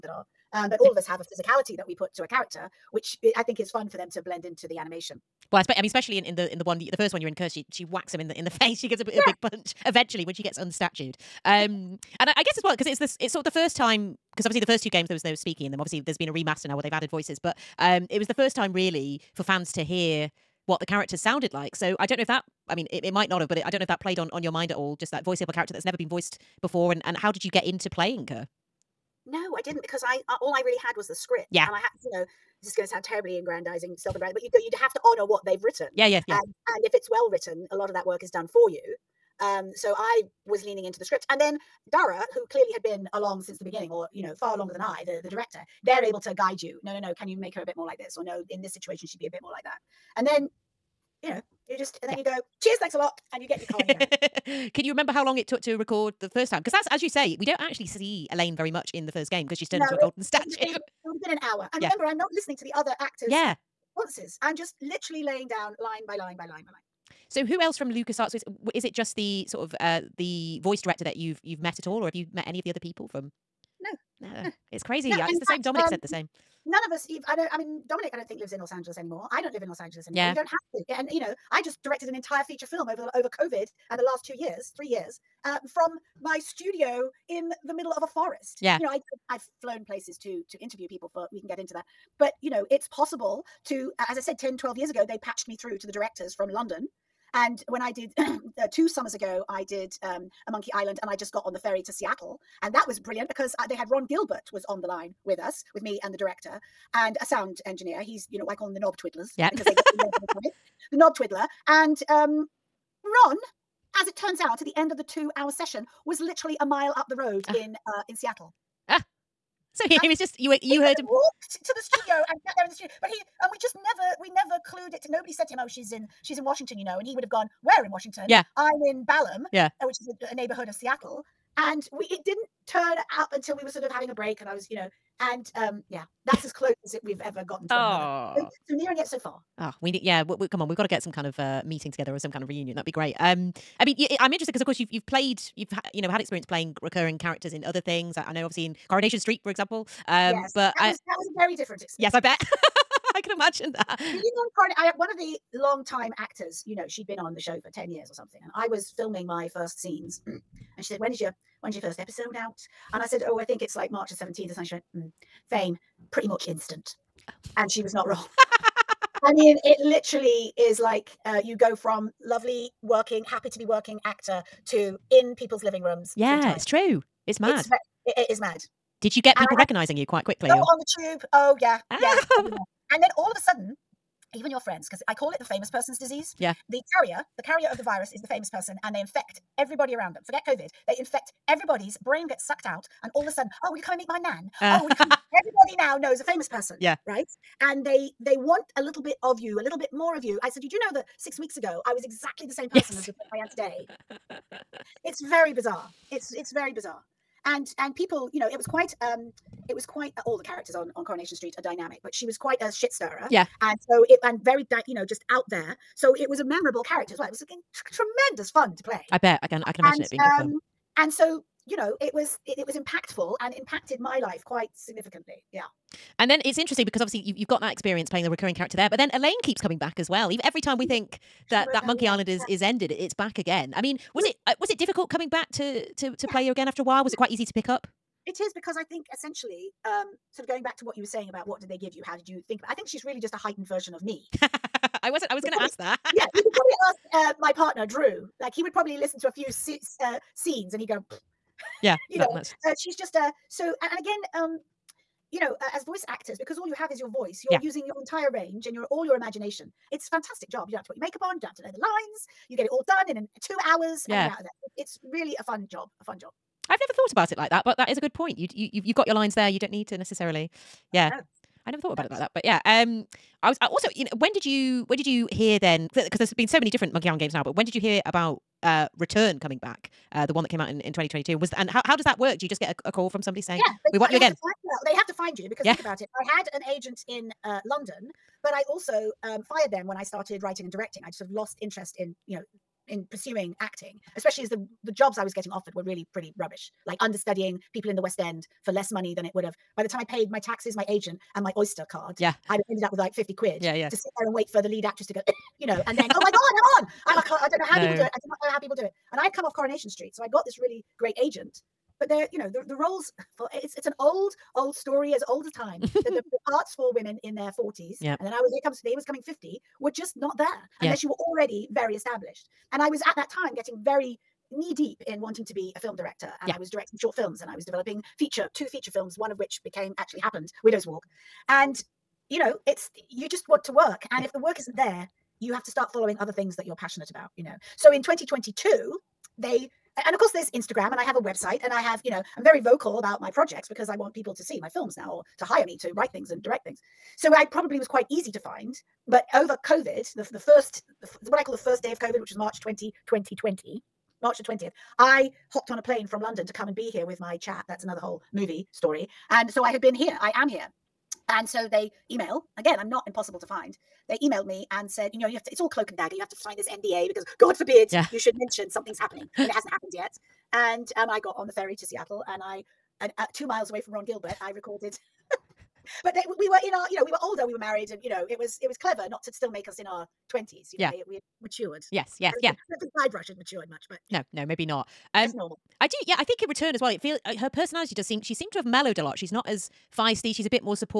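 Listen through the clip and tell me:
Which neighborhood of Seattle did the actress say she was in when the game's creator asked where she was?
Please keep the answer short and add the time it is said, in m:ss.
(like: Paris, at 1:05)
Ballard, at 2:09.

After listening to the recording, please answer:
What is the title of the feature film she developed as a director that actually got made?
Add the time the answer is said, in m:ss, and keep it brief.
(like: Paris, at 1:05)
Widow's Walk, at 5:30.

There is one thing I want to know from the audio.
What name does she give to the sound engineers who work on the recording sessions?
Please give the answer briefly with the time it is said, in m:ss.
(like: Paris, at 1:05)
knob twiddlers, at 1:48.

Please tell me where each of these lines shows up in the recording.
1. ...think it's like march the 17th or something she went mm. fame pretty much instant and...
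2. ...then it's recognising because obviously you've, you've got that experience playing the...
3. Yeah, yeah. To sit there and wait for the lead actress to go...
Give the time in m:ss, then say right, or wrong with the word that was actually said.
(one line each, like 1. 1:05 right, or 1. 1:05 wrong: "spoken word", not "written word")
1. 2:43 right
2. 3:46 wrong: "interesting", not "recognising"
3. 5:03 right.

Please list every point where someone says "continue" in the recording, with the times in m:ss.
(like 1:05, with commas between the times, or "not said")
not said.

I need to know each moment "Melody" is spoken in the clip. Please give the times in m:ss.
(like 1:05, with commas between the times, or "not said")
not said.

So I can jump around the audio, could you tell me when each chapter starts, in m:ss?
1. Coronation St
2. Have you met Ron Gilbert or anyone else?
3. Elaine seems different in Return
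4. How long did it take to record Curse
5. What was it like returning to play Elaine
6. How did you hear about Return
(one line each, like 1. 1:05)
1. 1:41
2. 0:36
3. 5:55
4. 0:18
5. 3:08
6. 4:01.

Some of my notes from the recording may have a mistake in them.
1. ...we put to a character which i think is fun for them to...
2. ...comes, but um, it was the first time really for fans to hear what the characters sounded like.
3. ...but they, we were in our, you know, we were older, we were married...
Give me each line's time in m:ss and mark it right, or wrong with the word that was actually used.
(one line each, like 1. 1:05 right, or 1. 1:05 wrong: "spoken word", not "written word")
1. 0:01 right
2. 0:17 wrong: "voices", not "comes"
3. 6:16 right.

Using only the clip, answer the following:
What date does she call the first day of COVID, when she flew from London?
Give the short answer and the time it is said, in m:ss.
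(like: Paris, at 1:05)
March 20, 2020, at 5:52.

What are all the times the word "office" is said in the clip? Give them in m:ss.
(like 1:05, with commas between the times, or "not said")
not said.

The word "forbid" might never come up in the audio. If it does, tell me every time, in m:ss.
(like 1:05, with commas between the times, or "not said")
6:07.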